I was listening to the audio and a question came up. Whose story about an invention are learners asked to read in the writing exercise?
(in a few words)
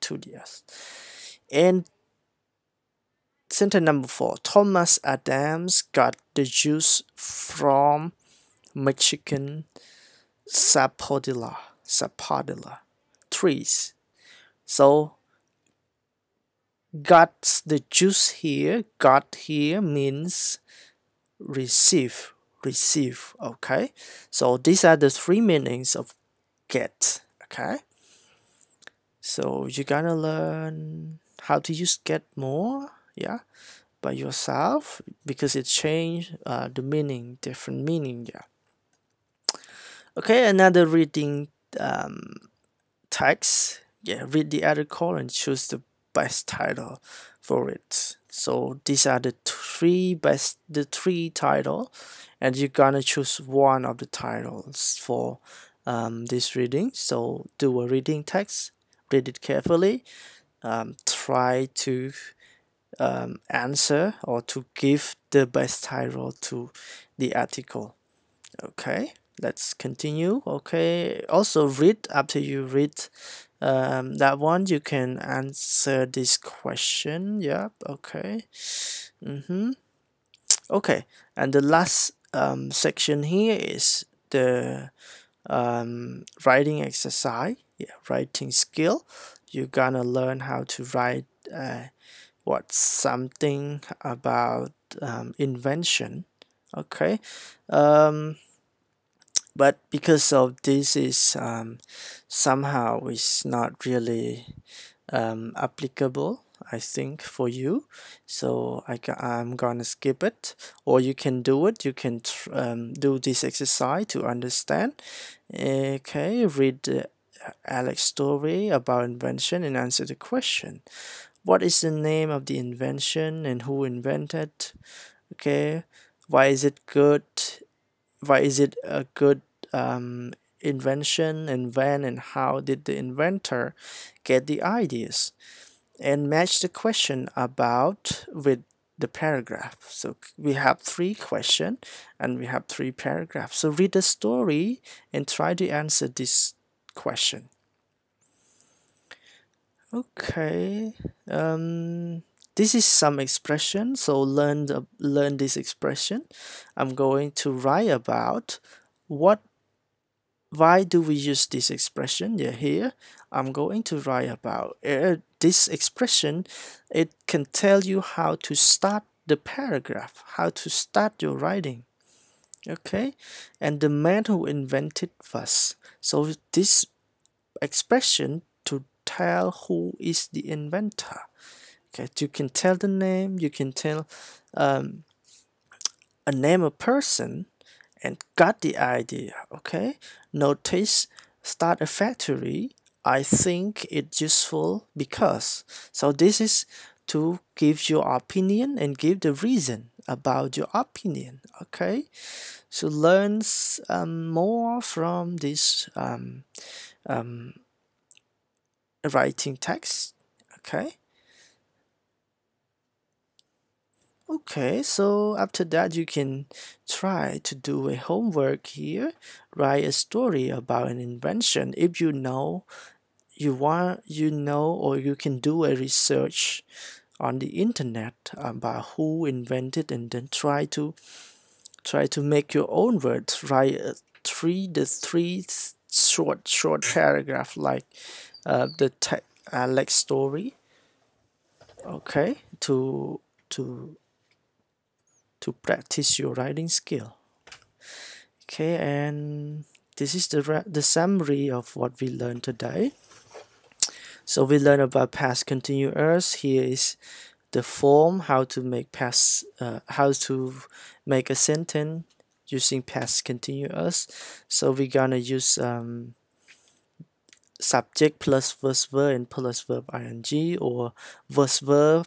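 Alex.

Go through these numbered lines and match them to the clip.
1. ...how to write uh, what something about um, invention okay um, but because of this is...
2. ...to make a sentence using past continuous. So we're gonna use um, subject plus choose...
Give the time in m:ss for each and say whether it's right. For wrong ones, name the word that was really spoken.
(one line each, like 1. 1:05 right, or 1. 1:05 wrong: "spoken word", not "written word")
1. 1:30 right
2. 4:20 wrong: "verse", not "choose".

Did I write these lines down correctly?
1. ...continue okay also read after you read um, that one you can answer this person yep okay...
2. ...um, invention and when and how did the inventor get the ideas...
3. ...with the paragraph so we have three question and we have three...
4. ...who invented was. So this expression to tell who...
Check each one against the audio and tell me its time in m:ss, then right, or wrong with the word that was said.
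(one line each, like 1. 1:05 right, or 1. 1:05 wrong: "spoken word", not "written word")
1. 1:09 wrong: "question", not "person"
2. 2:09 right
3. 2:18 right
4. 2:54 right.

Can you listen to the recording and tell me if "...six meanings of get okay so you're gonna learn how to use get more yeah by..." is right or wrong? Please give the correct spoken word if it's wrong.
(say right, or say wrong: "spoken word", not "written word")
wrong: "three", not "six".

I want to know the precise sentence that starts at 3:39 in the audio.
Write a story about an invention.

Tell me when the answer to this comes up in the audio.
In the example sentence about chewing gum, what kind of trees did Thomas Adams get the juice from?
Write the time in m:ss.
0:08.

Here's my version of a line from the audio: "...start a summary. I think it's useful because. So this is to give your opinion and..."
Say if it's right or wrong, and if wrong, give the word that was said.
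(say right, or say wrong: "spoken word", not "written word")
wrong: "factory", not "summary".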